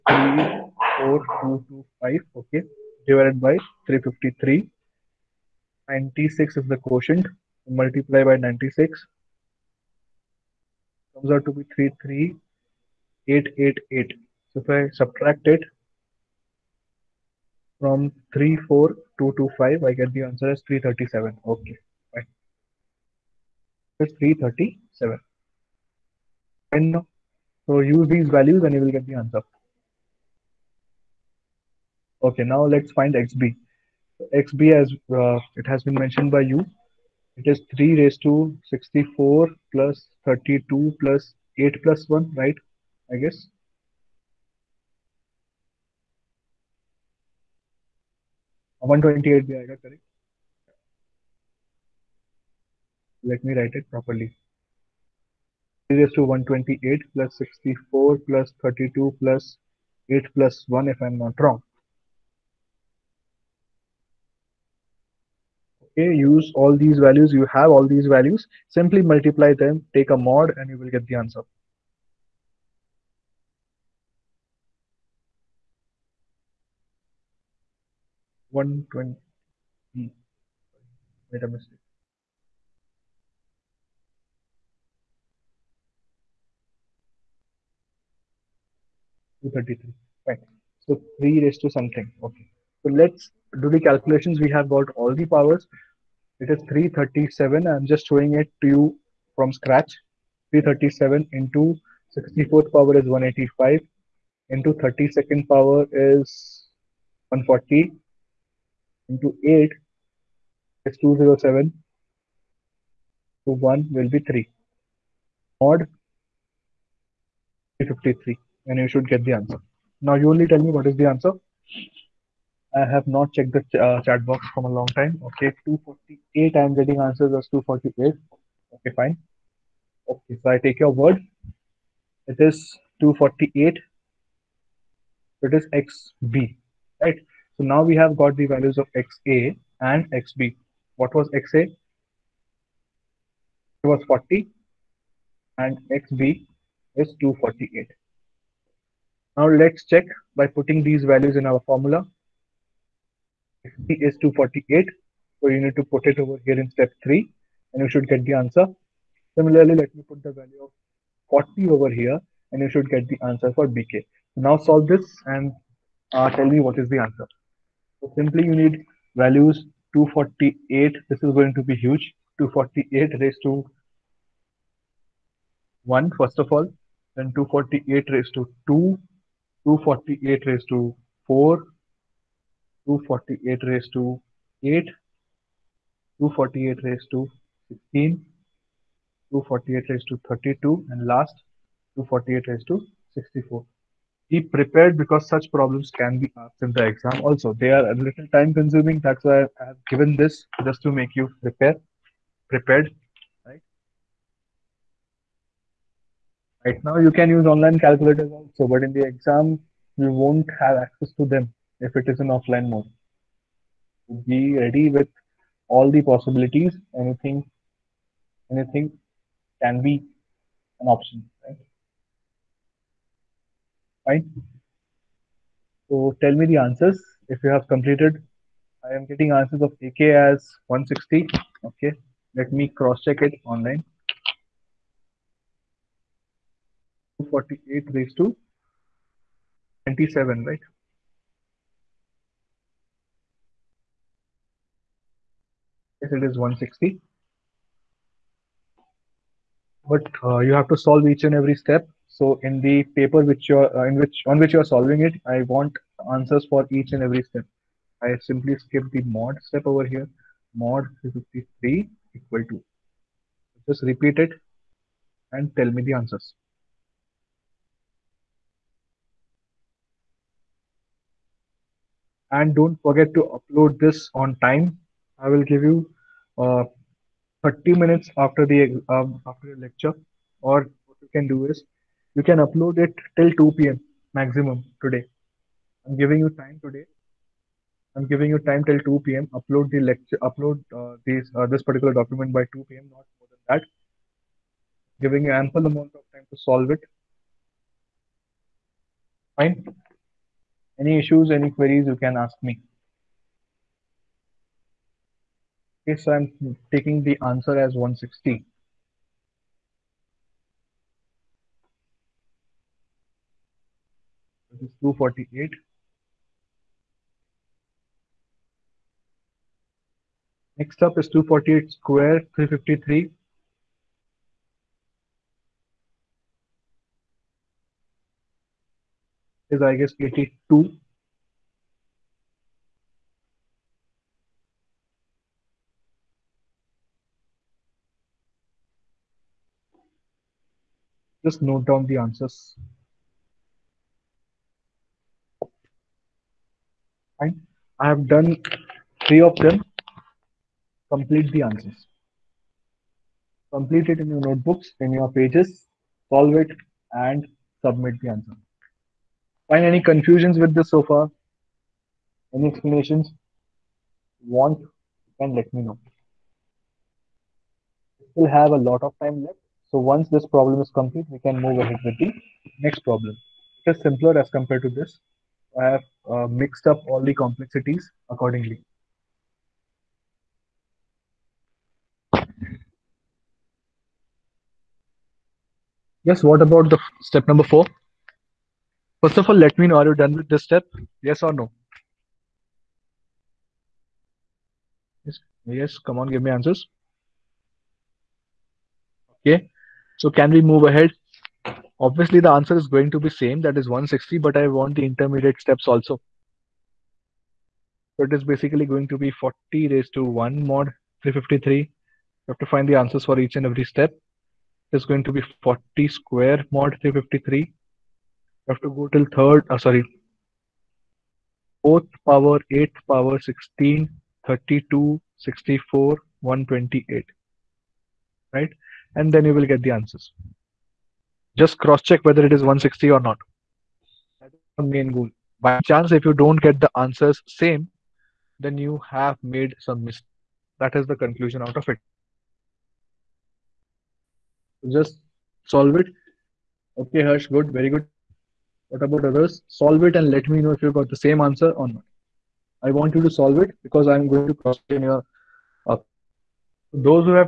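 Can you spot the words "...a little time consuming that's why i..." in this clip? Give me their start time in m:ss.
3:17.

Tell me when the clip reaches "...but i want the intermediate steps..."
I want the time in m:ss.
6:44.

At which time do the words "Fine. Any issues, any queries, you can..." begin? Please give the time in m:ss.
4:59.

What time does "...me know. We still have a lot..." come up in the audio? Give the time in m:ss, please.
6:05.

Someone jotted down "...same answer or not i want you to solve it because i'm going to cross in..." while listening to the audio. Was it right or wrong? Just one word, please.
right.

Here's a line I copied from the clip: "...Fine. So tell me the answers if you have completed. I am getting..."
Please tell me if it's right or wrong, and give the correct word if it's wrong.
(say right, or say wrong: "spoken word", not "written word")
right.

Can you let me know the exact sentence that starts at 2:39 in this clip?
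Similarly, let me put the value of 40 over here and you should get the answer for BK.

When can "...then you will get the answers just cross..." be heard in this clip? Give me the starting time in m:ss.
7:09.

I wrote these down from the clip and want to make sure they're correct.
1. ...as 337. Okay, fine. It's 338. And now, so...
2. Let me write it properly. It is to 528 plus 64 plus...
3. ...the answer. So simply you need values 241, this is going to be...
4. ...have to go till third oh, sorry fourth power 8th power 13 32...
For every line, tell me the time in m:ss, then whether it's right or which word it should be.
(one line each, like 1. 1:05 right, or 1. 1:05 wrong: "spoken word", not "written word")
1. 0:20 wrong: "337", not "338"
2. 0:53 wrong: "128", not "528"
3. 2:46 wrong: "248", not "241"
4. 6:58 wrong: "16", not "13".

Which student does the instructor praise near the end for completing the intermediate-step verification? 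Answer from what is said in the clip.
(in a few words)
Harsh.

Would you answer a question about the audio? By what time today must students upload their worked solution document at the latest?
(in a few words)
2 p.m.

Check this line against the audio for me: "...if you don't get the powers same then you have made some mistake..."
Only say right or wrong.
wrong.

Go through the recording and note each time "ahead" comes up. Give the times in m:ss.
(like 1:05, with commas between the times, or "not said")
6:11, 6:40.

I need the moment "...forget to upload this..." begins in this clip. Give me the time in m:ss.
4:32.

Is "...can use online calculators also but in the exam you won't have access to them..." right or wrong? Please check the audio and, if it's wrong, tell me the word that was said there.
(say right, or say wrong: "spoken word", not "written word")
right.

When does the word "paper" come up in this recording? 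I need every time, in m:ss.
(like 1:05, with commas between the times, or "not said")
4:12.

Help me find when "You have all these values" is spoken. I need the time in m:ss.
1:07.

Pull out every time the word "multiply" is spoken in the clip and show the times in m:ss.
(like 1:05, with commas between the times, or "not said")
0:07, 1:09.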